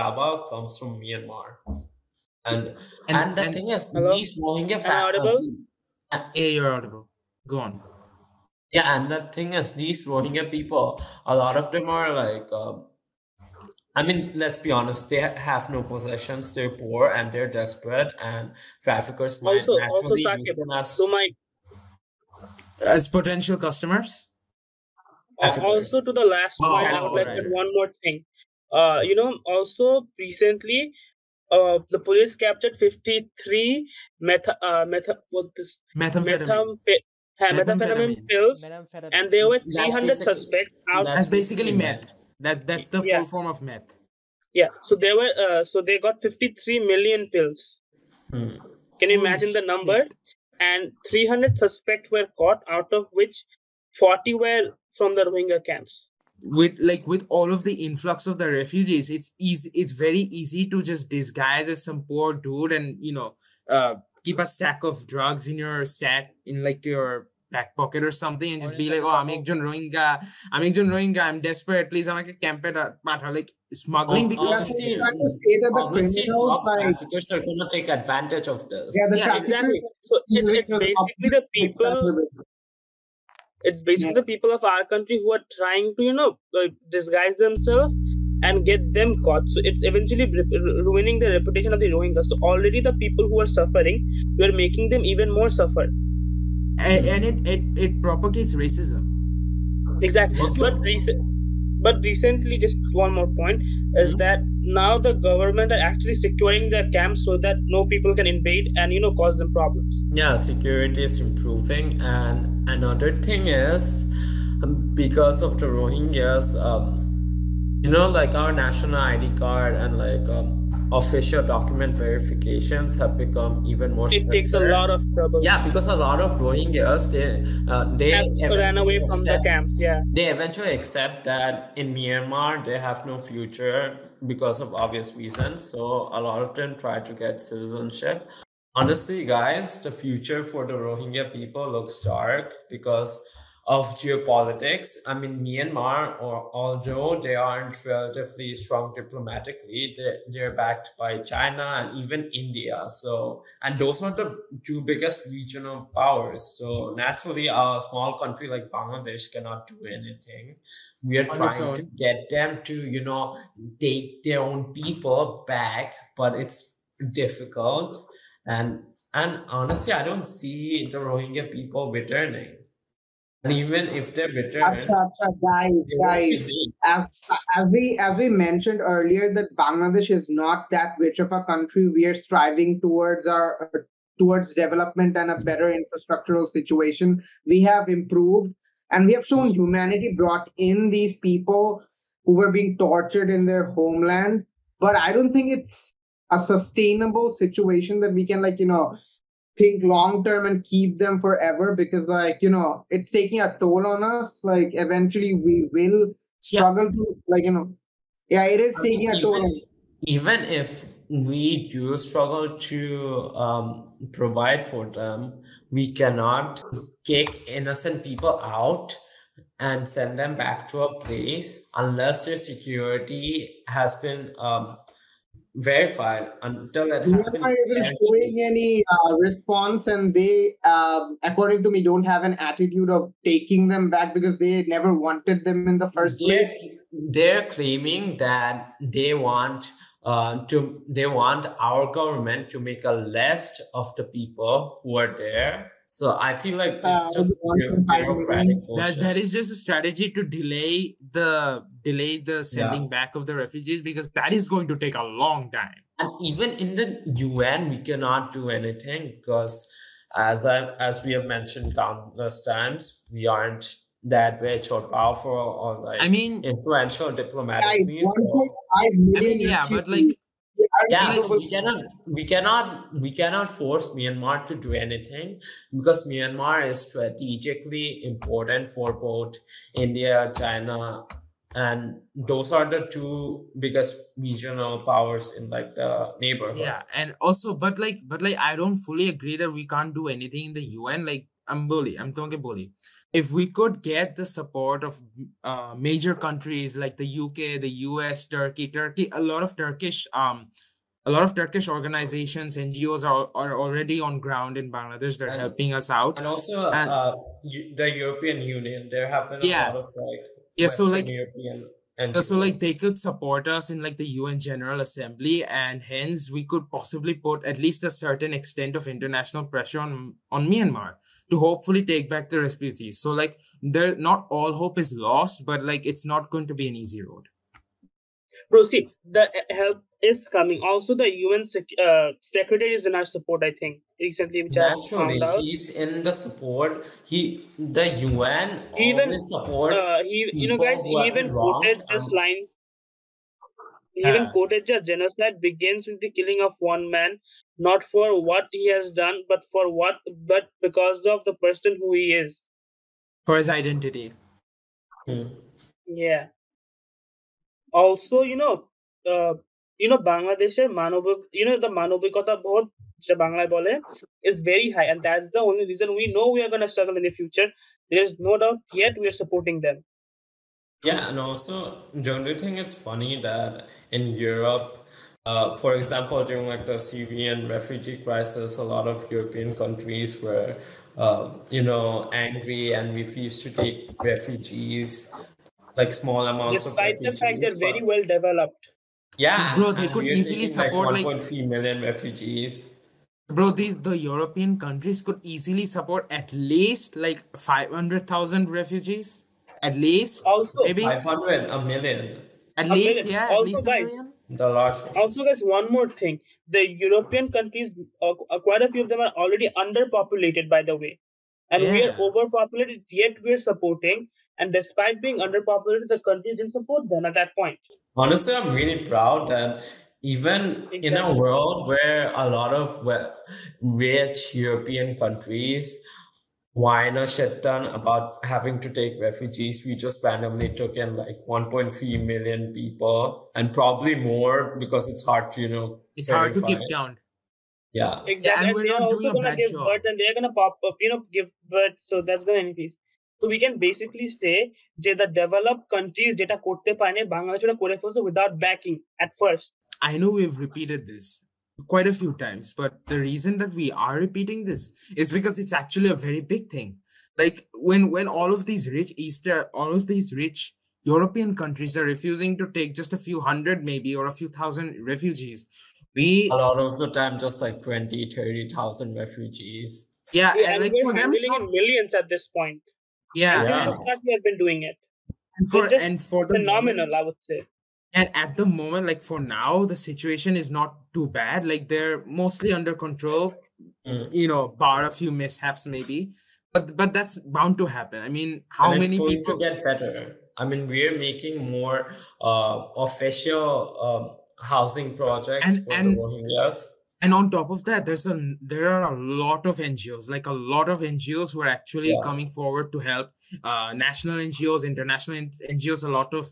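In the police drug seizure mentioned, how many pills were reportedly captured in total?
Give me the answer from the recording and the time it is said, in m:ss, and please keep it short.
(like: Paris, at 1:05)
53 million, at 0:46.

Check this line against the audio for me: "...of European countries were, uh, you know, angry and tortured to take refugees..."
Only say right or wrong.
wrong.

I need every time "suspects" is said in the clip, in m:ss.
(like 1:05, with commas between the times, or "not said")
0:40, 0:51.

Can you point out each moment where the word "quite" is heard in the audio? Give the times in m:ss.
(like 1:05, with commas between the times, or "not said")
6:48, 7:31.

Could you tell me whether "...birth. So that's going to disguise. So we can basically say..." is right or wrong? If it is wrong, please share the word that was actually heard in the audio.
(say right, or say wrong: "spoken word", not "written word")
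wrong: "increase", not "disguise".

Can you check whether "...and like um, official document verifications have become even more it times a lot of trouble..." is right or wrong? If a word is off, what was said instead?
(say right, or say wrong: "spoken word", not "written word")
wrong: "takes", not "times".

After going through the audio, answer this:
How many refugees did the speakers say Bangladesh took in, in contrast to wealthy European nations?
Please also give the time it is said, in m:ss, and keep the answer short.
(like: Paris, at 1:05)
1.3 million, at 7:11.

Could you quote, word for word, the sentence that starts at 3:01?
We are striving towards our towards development and a better infrastructural situation.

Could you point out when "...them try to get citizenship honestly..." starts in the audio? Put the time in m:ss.
2:16.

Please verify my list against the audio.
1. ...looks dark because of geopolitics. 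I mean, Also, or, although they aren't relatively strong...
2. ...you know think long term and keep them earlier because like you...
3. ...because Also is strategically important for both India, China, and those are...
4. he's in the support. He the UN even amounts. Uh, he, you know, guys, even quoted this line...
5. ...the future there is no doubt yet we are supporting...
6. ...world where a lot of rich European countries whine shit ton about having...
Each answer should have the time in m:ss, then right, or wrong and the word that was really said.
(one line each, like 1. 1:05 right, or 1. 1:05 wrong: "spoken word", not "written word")
1. 2:21 wrong: "Myanmar", not "Also"
2. 3:18 wrong: "forever", not "earlier"
3. 4:35 wrong: "Myanmar", not "Also"
4. 5:35 wrong: "supports", not "amounts"
5. 6:07 right
6. 7:01 right.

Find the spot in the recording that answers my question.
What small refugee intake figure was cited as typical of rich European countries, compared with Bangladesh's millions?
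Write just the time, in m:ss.
7:47.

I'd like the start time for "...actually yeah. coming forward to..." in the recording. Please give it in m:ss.
8:21.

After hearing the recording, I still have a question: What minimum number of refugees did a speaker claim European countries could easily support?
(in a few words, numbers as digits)
500,000.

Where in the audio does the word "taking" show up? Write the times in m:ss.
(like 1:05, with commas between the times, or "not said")
3:23, 3:28, 3:53.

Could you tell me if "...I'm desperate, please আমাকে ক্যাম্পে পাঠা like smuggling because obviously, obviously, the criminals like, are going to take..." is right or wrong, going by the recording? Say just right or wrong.
right.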